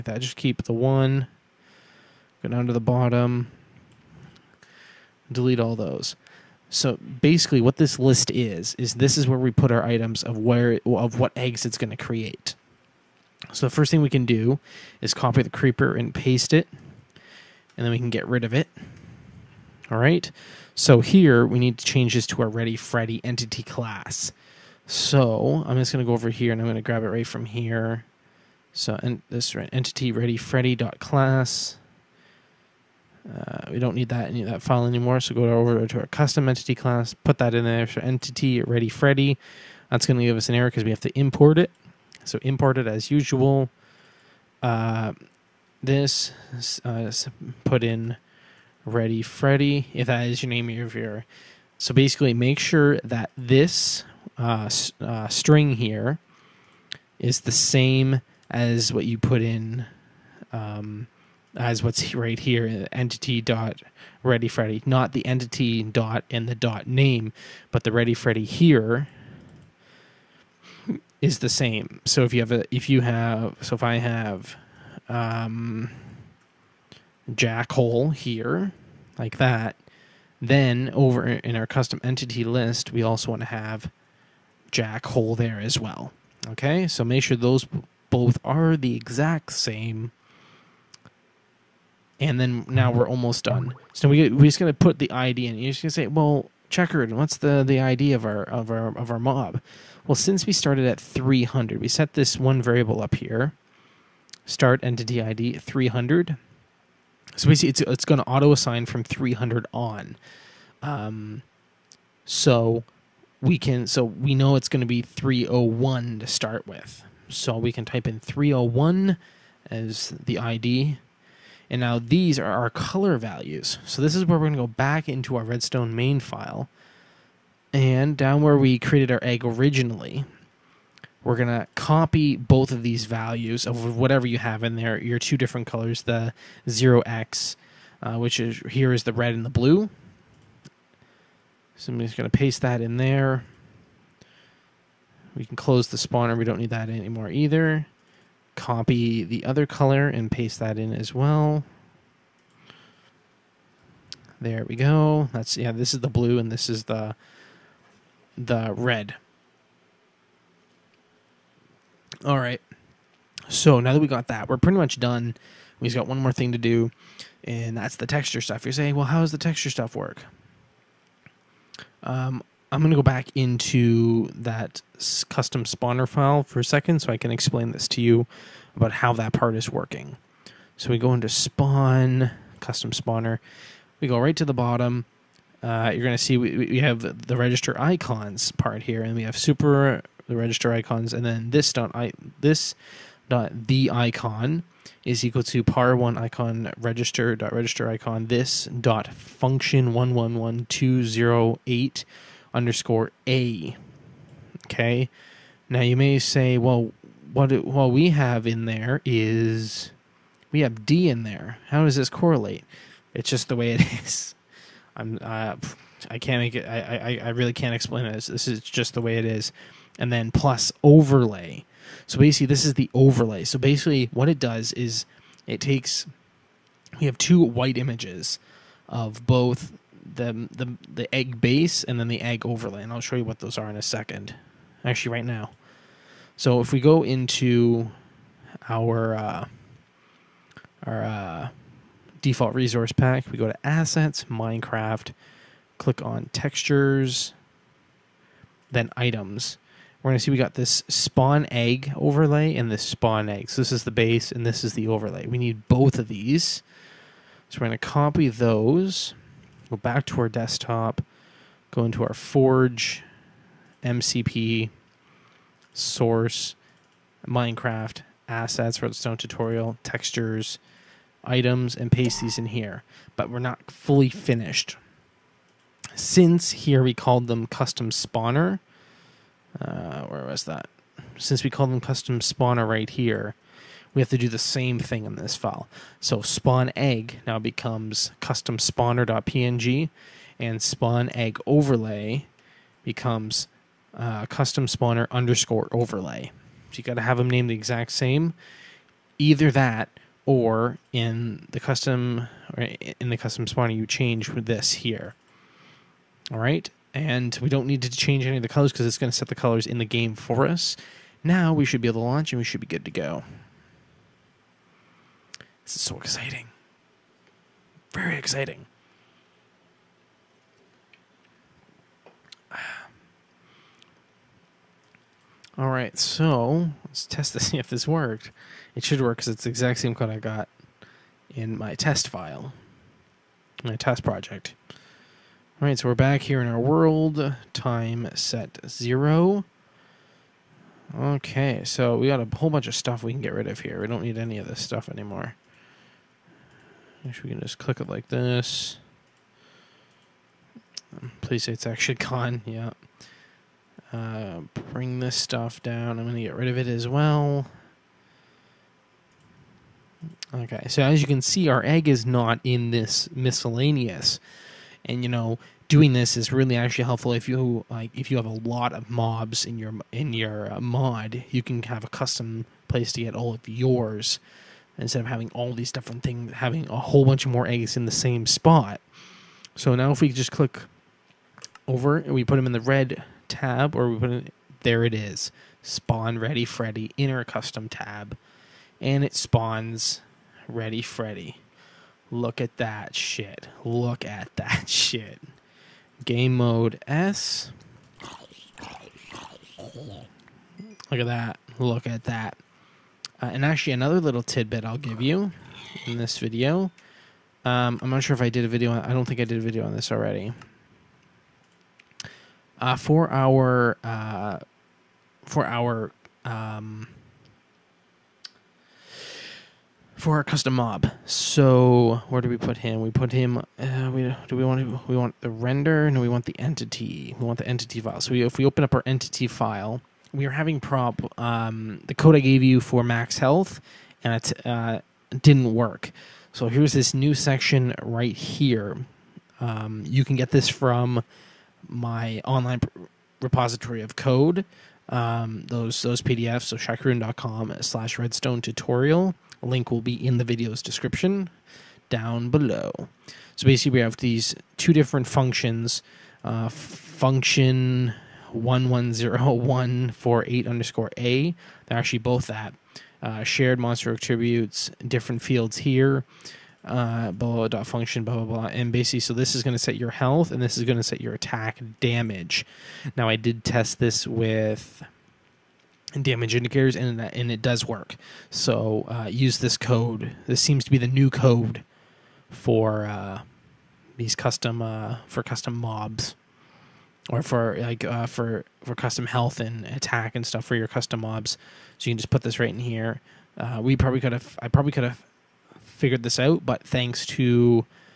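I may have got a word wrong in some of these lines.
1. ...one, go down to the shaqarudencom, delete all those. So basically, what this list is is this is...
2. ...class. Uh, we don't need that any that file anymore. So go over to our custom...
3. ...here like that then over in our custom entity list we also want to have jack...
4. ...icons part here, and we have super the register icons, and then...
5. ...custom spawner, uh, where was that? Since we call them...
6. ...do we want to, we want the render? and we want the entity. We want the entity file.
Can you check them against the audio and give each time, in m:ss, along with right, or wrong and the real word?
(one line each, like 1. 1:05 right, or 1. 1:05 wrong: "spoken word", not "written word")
1. 0:00 wrong: "bottom", not "shaqarudencom"
2. 0:30 right
3. 1:18 right
4. 3:07 right
5. 4:37 right
6. 7:04 right.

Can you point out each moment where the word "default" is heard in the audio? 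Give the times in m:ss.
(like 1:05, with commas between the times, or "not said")
4:02.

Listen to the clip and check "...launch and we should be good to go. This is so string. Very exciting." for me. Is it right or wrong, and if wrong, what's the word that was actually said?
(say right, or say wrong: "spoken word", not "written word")
wrong: "exciting", not "string".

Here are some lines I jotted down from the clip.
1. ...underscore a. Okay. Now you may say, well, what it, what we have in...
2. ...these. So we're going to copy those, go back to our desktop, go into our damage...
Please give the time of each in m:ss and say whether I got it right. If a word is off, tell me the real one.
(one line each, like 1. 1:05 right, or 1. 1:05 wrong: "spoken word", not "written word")
1. 3:22 right
2. 4:16 wrong: "forge", not "damage".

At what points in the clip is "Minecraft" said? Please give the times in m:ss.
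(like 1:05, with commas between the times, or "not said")
4:04, 4:27.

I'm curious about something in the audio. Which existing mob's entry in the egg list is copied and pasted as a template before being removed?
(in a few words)
Creeper.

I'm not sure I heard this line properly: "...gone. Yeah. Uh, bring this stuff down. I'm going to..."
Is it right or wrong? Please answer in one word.
right.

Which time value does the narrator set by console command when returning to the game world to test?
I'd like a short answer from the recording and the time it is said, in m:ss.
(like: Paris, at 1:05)
Time set zero, at 5:37.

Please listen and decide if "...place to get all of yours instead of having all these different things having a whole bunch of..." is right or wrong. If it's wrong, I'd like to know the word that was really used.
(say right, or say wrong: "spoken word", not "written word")
right.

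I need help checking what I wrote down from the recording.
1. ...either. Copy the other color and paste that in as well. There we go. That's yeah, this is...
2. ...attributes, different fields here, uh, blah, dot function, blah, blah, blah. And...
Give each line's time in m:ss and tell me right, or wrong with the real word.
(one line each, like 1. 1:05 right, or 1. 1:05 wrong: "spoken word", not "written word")
1. 2:27 right
2. 7:43 right.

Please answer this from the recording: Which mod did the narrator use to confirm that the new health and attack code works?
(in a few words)
damage indicators.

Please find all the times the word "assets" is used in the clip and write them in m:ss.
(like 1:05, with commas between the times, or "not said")
4:03, 4:28.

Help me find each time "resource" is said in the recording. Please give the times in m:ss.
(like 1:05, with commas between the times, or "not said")
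4:02.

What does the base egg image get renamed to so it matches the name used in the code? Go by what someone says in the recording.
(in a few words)
custom spawner.png.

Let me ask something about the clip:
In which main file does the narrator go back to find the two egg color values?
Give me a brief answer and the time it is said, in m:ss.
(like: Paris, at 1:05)
Redstone main file, at 2:05.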